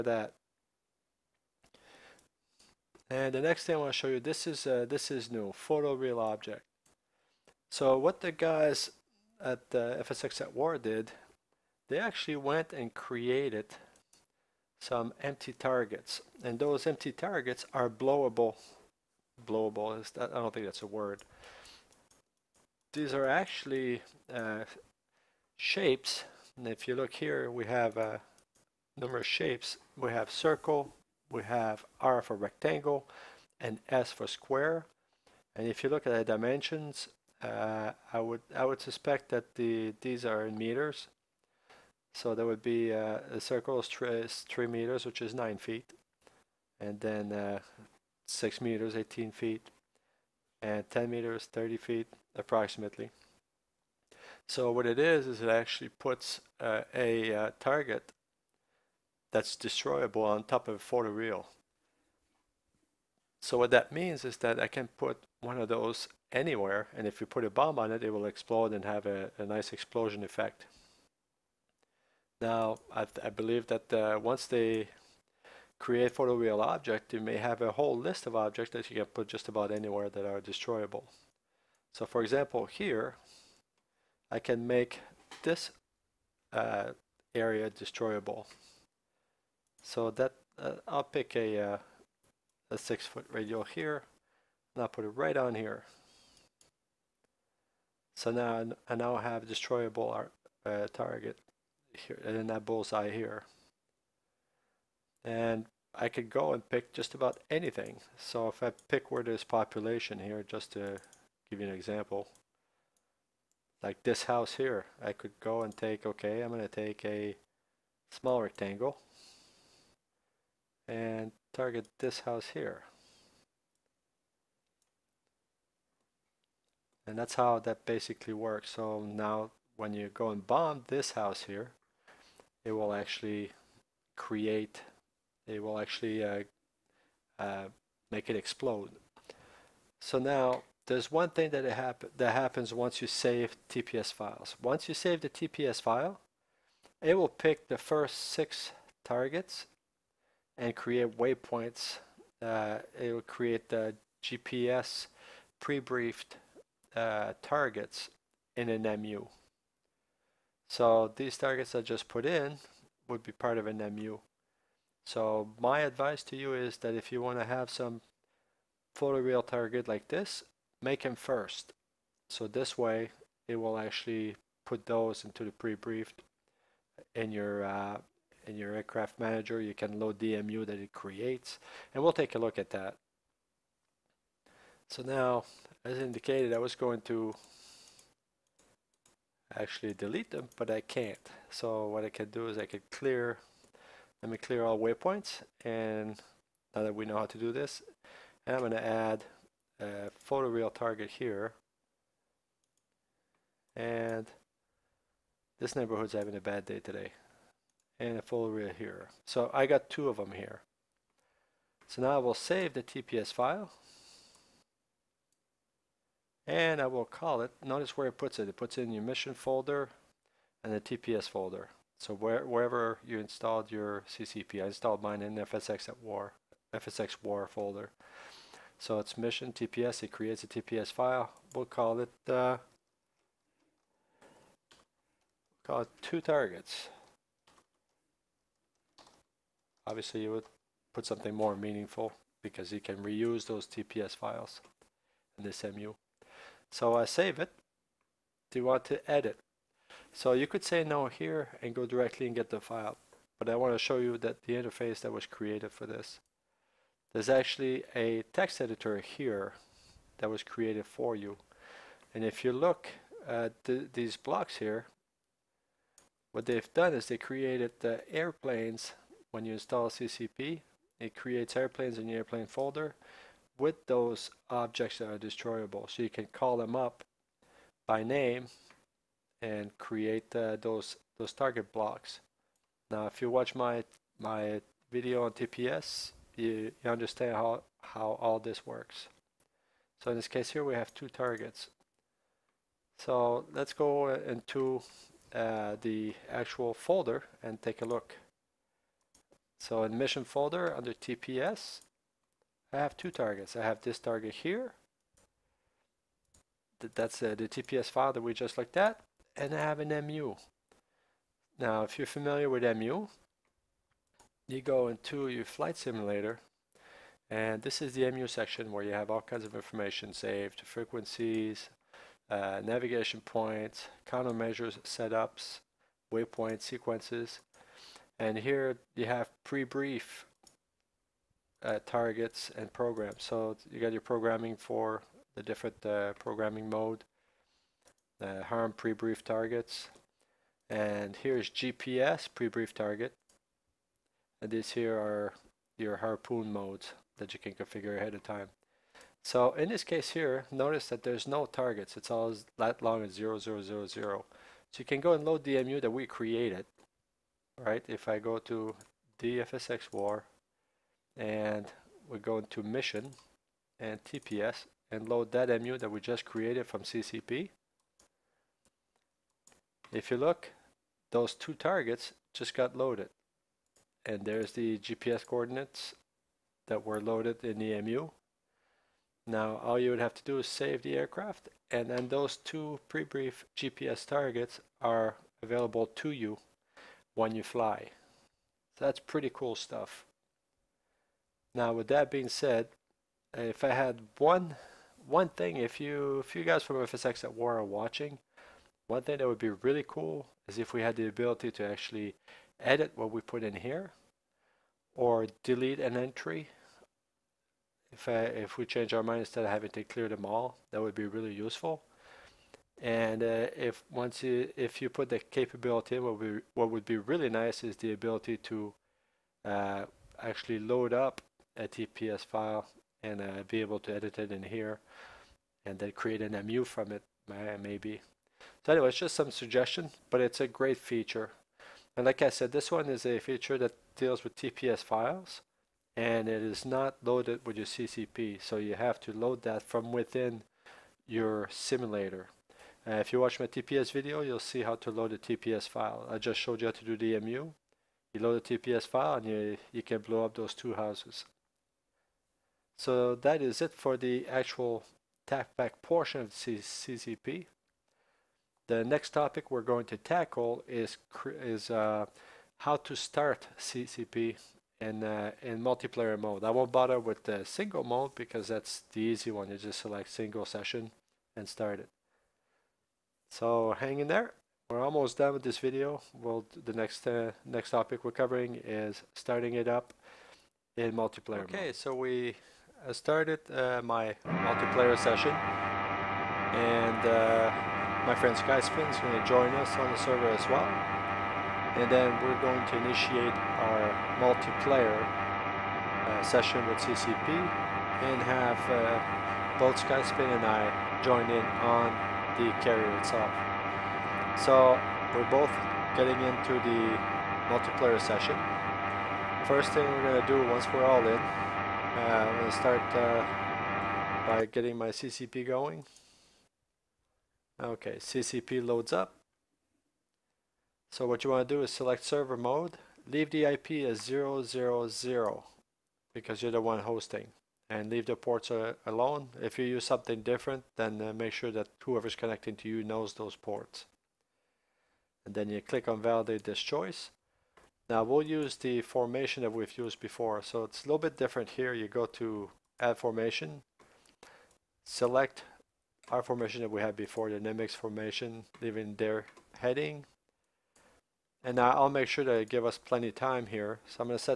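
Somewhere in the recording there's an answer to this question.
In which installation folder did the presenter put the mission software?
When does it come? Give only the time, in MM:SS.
03:46.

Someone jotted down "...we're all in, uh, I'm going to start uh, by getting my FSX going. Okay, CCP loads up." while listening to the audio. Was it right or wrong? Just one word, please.
wrong.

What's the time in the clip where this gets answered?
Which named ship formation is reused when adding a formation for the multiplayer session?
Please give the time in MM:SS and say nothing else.
09:07.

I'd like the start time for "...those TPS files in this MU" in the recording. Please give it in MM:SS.
04:03.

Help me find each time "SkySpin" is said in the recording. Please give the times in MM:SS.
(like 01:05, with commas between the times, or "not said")
08:08, 08:19.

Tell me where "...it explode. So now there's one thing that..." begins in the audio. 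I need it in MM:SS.
02:18.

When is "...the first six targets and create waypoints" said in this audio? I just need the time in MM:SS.
02:27.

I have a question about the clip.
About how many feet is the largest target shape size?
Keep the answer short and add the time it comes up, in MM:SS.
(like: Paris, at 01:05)
30 feet, at 00:51.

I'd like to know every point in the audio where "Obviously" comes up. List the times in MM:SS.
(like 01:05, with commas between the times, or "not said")
03:59.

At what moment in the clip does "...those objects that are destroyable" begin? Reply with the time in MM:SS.
04:33.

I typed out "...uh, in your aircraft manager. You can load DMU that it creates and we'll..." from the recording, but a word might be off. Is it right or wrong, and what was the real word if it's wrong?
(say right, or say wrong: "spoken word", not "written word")
right.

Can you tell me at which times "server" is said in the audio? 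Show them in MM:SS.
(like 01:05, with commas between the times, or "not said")
08:09, 08:42.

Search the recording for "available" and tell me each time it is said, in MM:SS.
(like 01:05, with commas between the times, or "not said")
06:25.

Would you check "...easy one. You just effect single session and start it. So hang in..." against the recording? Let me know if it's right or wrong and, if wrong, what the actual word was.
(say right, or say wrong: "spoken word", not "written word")
wrong: "select", not "effect".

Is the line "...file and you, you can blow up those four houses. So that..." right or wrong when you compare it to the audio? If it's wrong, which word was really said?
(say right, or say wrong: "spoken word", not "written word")
wrong: "two", not "four".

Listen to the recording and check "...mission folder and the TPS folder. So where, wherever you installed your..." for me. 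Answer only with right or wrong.
right.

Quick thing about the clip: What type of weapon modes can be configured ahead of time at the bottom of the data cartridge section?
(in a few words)
harpoon.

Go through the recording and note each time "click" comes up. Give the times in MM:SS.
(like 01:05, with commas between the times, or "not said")
08:55.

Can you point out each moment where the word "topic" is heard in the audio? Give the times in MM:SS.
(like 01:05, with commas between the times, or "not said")
07:39, 07:57.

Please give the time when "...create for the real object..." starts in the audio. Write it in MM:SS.
01:15.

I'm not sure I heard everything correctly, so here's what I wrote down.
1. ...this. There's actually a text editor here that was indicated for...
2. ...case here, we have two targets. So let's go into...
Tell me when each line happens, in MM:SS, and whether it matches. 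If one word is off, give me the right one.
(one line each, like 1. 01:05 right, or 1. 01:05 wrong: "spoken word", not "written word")
1. 04:15 wrong: "created", not "indicated"
2. 04:50 right.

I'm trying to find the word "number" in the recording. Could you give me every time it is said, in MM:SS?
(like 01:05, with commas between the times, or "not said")
00:28.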